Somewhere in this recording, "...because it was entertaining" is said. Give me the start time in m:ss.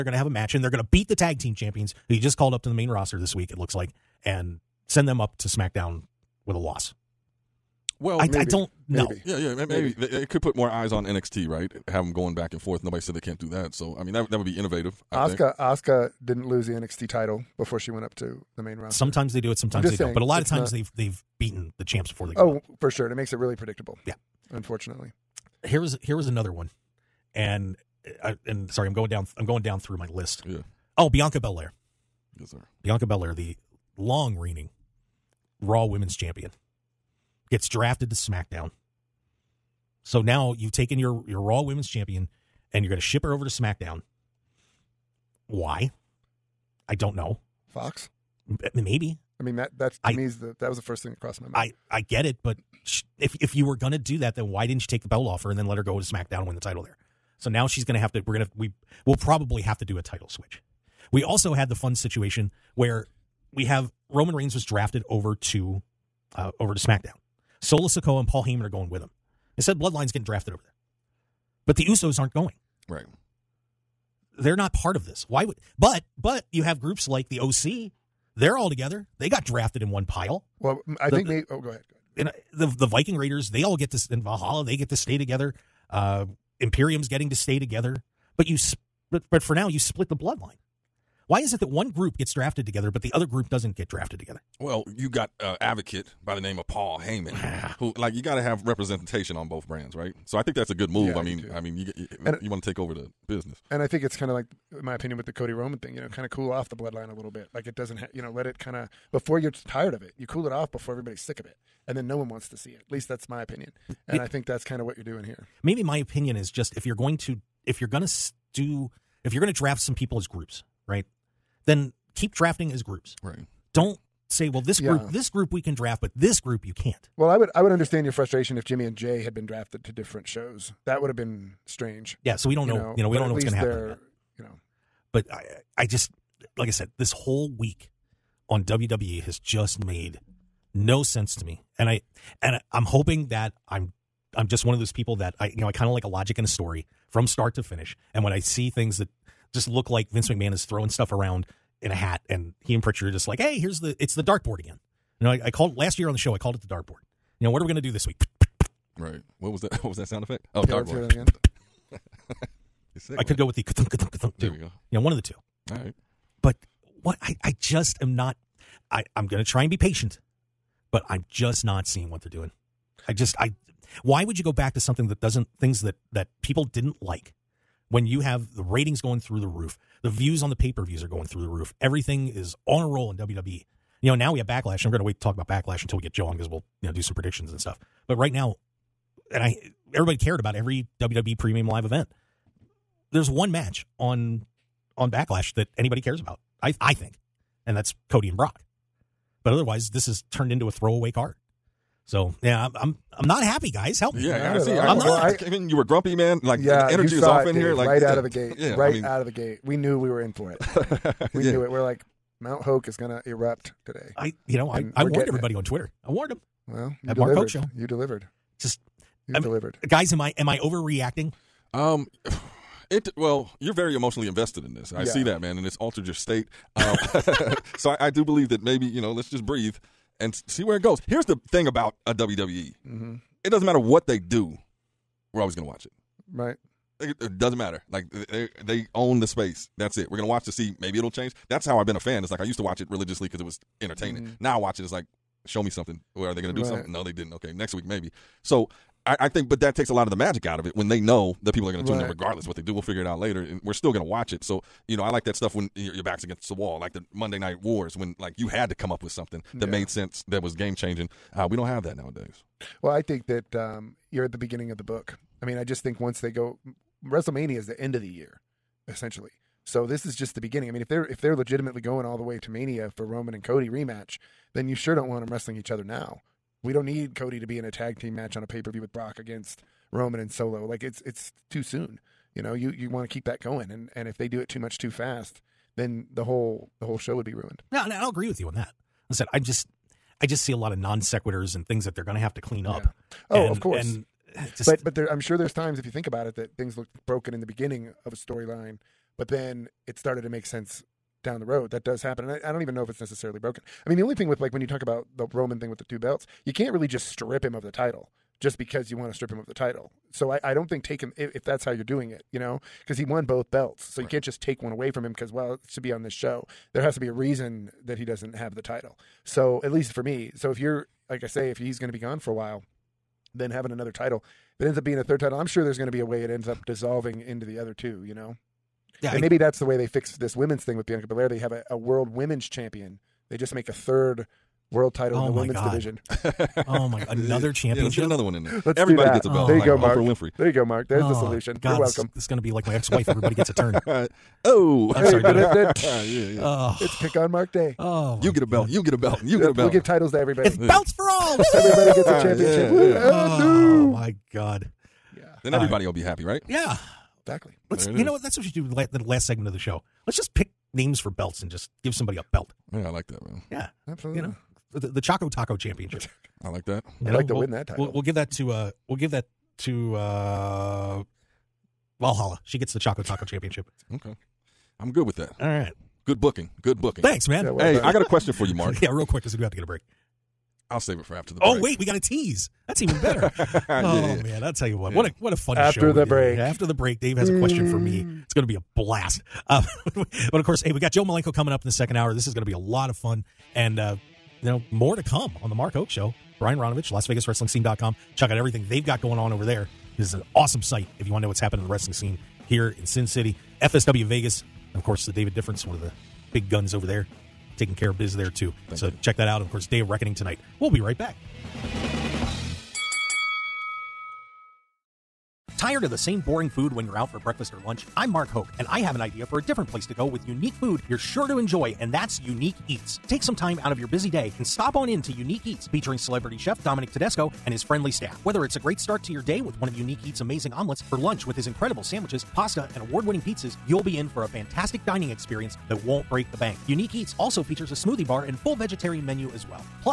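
4:03.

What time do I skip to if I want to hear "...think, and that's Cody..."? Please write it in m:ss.
3:16.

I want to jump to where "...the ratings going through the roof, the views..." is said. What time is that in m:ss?
2:58.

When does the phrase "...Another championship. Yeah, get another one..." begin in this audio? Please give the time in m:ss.
5:37.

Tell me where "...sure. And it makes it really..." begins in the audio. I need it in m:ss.
0:22.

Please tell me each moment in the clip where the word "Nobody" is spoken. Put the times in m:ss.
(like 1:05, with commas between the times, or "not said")
0:12.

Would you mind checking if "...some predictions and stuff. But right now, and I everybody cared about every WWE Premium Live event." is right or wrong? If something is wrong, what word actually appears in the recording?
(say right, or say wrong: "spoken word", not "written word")
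right.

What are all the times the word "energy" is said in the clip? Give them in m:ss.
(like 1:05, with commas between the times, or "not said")
3:26.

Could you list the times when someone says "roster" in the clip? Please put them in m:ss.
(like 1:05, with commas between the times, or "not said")
0:02, 0:18.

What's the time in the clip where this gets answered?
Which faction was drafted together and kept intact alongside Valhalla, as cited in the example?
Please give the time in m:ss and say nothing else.
1:22.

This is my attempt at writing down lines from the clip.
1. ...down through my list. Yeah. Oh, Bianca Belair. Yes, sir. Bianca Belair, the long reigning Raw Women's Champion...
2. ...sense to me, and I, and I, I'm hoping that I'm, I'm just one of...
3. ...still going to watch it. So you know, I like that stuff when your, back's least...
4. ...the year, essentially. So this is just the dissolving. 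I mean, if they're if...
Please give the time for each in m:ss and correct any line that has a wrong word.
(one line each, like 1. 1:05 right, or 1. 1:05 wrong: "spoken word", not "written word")
1. 0:29 right
2. 2:21 right
3. 4:13 wrong: "against", not "least"
4. 4:28 wrong: "beginning", not "dissolving".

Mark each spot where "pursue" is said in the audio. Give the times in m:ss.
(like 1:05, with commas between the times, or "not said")
not said.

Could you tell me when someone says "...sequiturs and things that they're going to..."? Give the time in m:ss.
4:51.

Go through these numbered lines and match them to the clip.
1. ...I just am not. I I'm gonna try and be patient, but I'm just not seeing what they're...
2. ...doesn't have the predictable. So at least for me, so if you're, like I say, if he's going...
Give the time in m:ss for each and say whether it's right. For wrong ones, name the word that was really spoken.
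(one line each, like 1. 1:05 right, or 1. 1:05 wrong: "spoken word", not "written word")
1. 2:47 right
2. 5:18 wrong: "title", not "predictable".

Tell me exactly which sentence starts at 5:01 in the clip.
That does happen, and I, I don't even know if it's necessarily broken.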